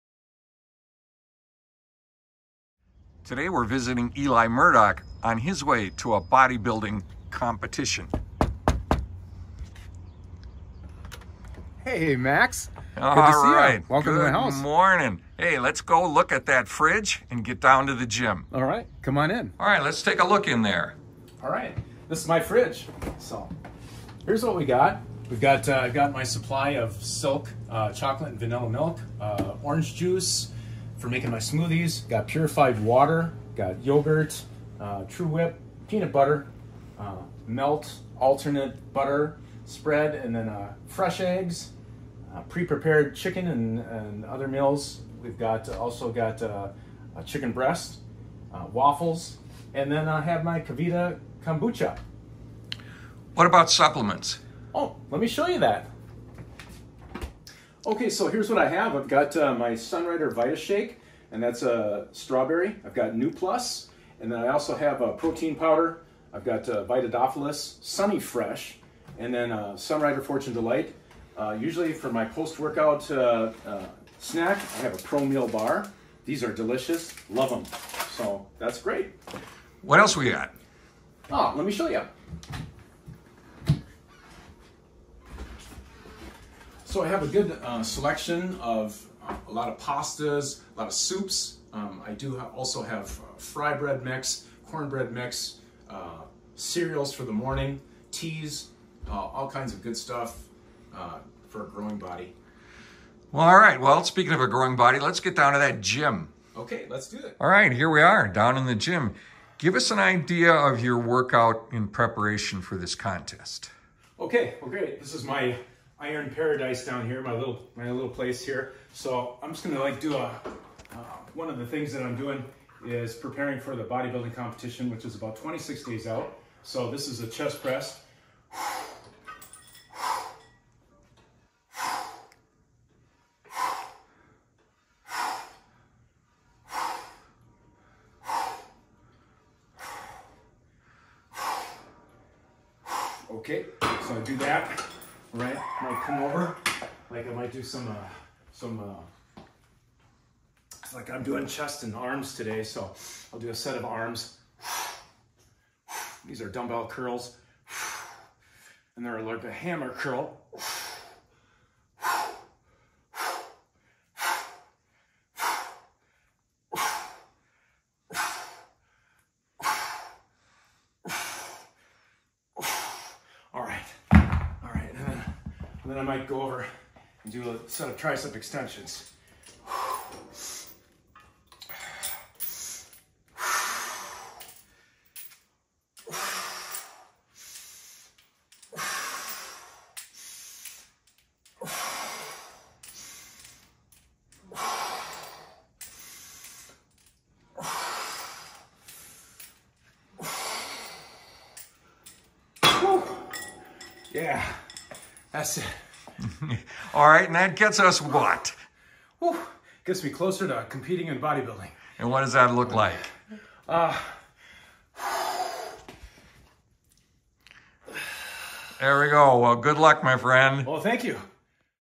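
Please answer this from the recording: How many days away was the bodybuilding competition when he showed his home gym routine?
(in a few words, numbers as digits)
26.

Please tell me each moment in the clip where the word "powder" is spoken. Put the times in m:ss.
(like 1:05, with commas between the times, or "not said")
1:05.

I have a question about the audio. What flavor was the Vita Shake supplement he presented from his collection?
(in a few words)
Strawberry.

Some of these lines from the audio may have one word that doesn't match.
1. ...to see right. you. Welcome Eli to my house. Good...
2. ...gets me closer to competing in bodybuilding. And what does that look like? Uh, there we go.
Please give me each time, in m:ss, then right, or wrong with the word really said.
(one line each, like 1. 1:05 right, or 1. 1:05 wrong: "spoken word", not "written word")
1. 0:13 wrong: "Good", not "Eli"
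2. 3:29 right.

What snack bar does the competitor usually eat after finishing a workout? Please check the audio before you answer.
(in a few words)
Pro Meal bar.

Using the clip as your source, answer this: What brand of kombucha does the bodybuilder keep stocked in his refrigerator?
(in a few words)
KeVita.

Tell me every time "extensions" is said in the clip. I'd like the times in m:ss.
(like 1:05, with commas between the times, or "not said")
2:58.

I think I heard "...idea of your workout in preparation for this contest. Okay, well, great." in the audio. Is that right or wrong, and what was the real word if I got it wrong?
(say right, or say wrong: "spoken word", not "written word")
right.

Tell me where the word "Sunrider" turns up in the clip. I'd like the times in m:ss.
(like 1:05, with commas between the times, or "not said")
0:59, 1:09.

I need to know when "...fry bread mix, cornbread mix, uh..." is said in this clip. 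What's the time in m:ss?
1:33.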